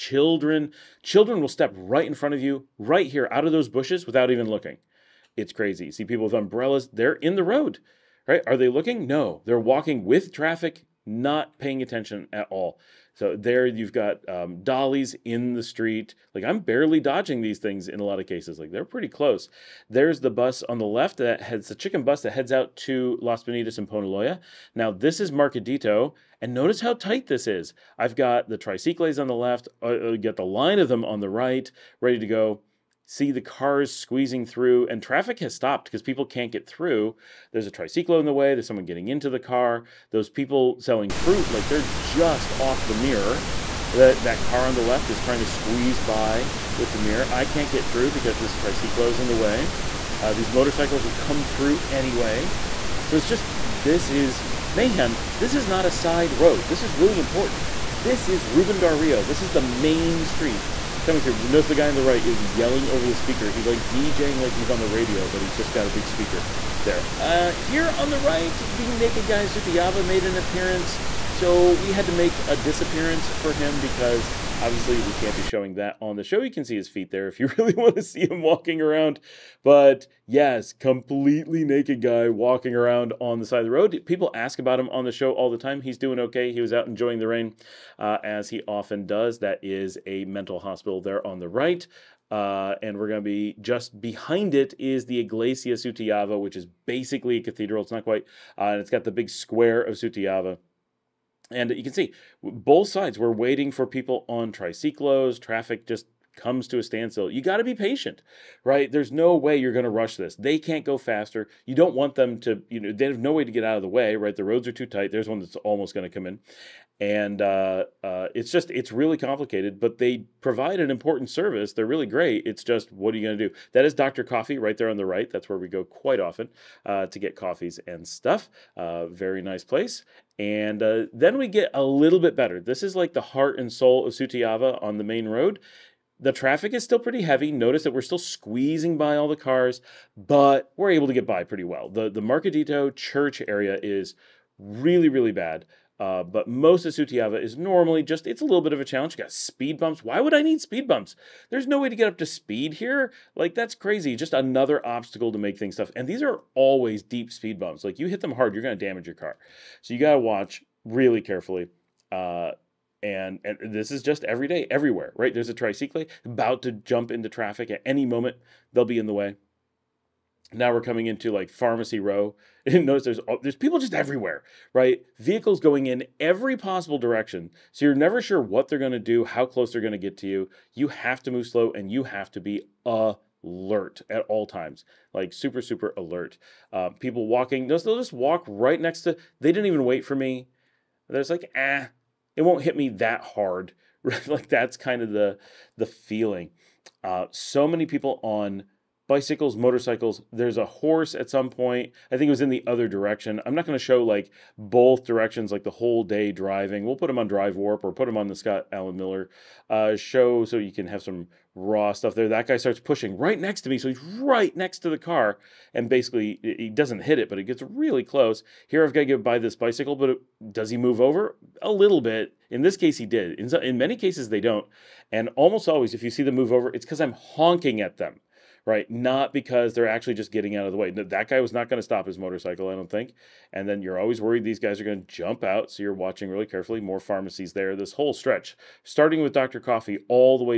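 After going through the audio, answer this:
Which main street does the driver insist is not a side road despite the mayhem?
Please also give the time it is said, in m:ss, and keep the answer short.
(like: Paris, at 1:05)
Ruben Dario, at 0:58.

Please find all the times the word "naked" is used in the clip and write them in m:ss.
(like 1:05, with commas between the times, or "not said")
1:08, 1:21.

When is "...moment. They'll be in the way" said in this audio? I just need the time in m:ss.
2:48.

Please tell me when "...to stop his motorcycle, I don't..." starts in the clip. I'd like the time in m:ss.
3:51.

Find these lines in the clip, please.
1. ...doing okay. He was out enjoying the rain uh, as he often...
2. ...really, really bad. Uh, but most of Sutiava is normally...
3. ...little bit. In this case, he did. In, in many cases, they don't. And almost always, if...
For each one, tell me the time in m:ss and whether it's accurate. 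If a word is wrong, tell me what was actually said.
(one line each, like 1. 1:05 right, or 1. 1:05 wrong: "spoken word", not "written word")
1. 1:25 right
2. 2:24 right
3. 3:41 right.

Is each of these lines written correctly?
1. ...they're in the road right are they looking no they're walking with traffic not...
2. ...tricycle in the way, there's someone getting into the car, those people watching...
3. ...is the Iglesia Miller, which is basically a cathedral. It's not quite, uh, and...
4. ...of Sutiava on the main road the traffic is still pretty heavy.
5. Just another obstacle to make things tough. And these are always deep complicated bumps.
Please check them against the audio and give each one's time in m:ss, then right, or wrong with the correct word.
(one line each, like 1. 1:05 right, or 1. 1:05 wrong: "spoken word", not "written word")
1. 0:06 right
2. 0:37 wrong: "selling", not "watching"
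3. 1:34 wrong: "Sutiava", not "Miller"
4. 2:14 right
5. 2:34 wrong: "speed", not "complicated".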